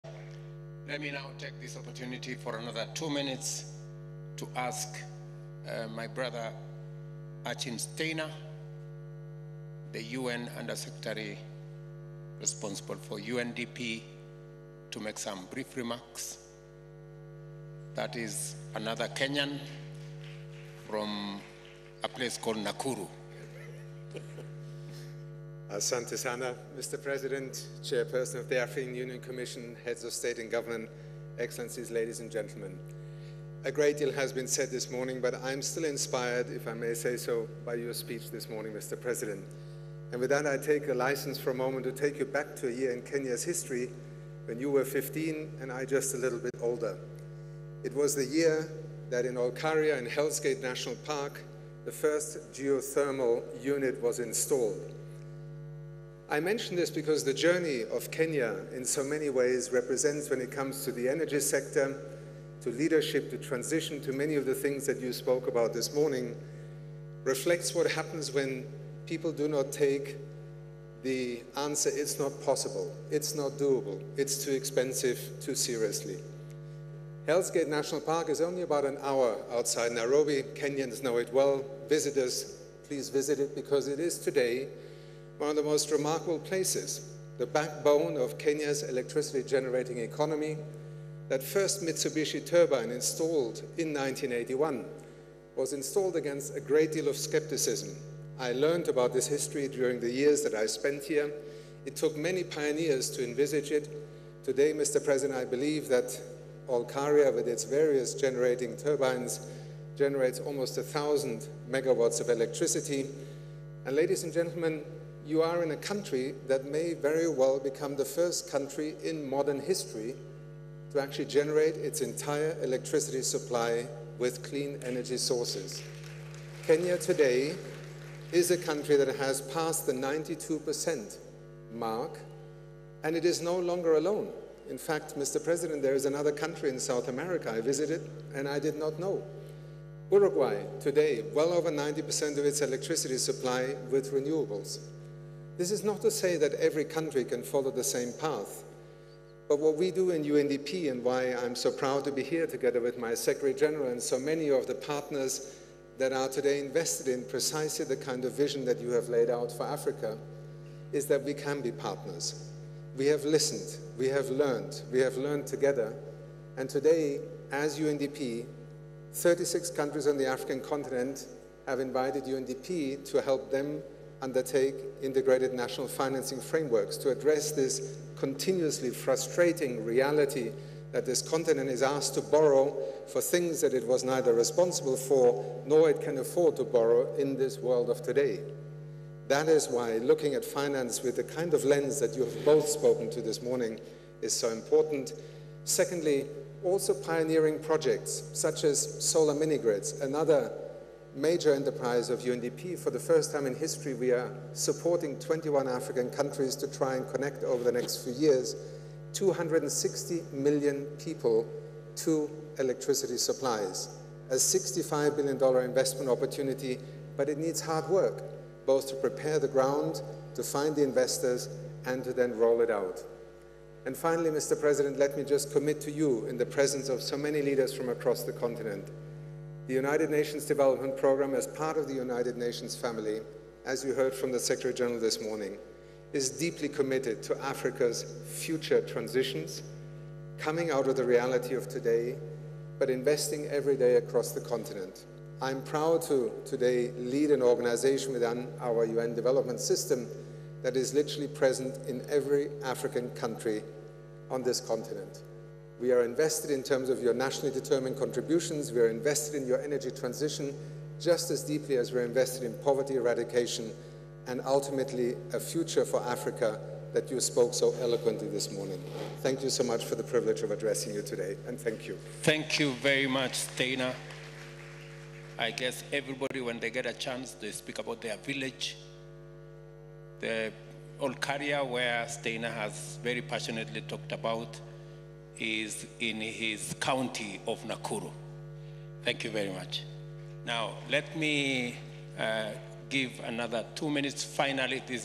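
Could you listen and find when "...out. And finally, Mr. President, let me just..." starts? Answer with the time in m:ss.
3:42.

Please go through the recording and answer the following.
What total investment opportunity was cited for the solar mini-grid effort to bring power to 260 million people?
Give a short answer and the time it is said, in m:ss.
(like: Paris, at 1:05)
$65 billion, at 3:34.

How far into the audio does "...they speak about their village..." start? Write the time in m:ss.
4:37.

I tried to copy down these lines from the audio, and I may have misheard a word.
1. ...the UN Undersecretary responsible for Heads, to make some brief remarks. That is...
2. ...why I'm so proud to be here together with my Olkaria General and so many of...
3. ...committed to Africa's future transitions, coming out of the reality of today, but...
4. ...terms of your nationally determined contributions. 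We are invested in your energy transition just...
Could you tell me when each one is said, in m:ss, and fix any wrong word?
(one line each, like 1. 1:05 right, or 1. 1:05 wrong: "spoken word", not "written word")
1. 0:09 wrong: "UNDP", not "Heads"
2. 2:31 wrong: "Secretary", not "Olkaria"
3. 3:56 right
4. 4:16 right.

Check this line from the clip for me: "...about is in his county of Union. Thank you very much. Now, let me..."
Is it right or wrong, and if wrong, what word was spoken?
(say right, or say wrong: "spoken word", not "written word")
wrong: "Nakuru", not "Union".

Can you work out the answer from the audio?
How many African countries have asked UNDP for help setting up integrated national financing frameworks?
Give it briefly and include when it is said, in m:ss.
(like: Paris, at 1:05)
36, at 2:49.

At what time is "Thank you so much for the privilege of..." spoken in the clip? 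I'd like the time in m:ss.
4:29.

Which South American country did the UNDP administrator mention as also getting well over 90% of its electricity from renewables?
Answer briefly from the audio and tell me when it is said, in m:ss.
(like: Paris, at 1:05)
Uruguay, at 2:20.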